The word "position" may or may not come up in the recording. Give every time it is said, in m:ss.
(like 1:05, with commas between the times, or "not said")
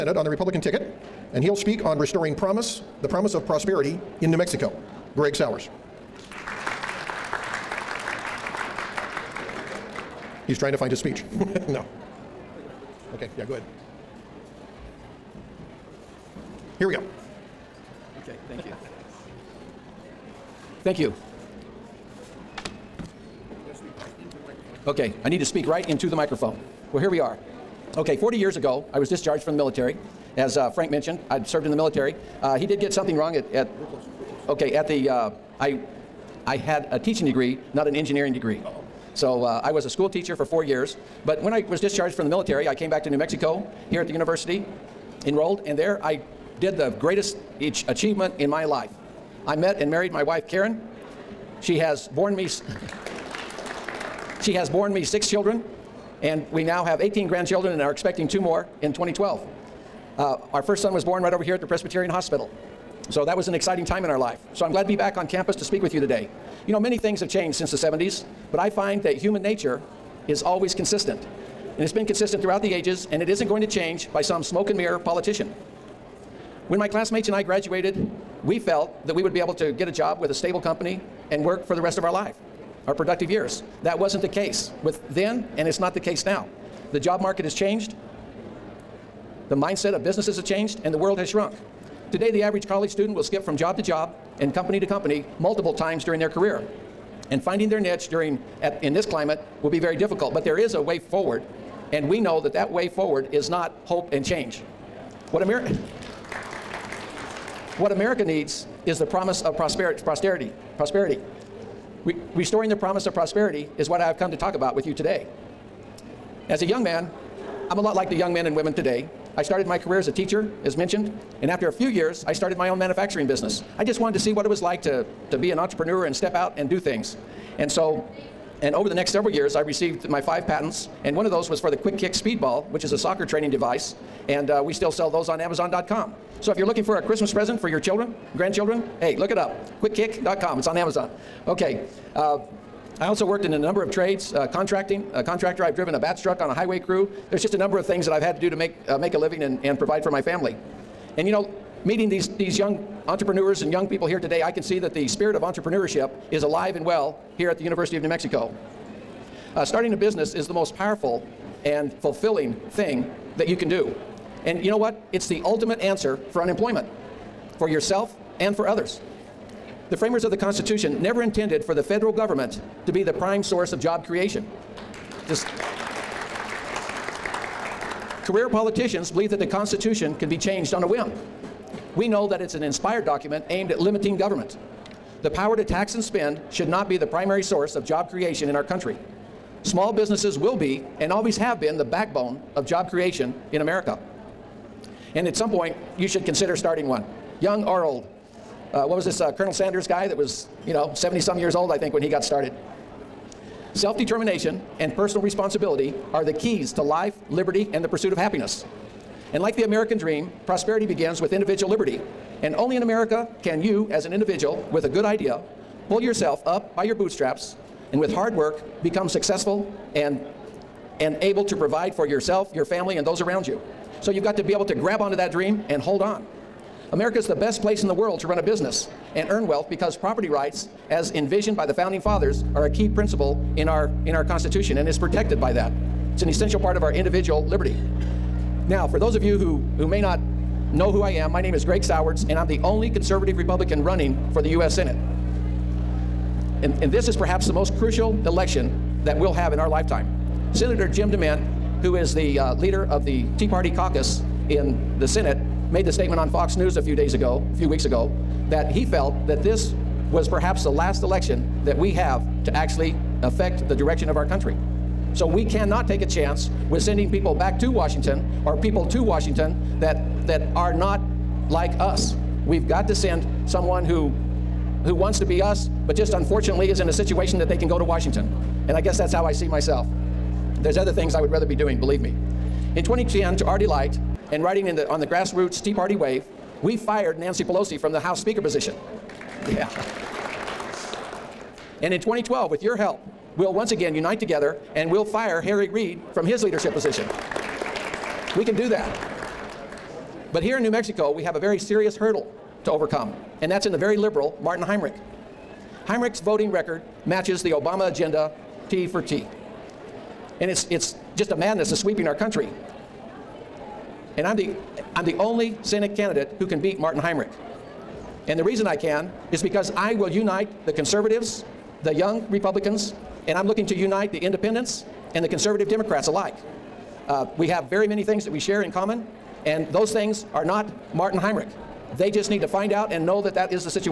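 4:48, 4:56.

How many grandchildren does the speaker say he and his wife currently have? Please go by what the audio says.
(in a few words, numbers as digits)
18.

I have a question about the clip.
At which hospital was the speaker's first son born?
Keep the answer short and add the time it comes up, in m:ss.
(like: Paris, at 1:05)
Presbyterian Hospital, at 1:01.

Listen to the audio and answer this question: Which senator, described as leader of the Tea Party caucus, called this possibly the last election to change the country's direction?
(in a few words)
Jim DeMint.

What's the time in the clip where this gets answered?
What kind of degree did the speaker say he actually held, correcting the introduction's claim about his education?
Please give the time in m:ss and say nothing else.
0:36.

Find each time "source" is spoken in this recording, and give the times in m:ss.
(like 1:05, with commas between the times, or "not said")
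2:53, 3:07.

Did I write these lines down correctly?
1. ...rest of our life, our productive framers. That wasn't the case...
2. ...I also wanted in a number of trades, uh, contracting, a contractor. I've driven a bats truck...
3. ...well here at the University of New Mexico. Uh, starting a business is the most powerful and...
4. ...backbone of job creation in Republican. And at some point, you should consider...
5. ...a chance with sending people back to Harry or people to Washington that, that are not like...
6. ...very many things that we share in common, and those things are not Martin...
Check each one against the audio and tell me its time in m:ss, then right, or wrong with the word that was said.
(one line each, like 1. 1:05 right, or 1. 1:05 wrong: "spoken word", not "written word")
1. 1:21 wrong: "years", not "framers"
2. 2:22 wrong: "worked", not "wanted"
3. 2:36 right
4. 3:11 wrong: "America", not "Republican"
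5. 4:26 wrong: "Washington", not "Harry"
6. 5:27 right.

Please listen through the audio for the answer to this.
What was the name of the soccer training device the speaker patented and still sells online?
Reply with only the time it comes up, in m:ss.
2:11.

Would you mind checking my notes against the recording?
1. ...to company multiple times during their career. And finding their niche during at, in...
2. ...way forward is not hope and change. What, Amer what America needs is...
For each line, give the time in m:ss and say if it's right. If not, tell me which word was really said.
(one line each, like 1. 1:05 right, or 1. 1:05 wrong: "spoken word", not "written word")
1. 1:34 right
2. 1:42 right.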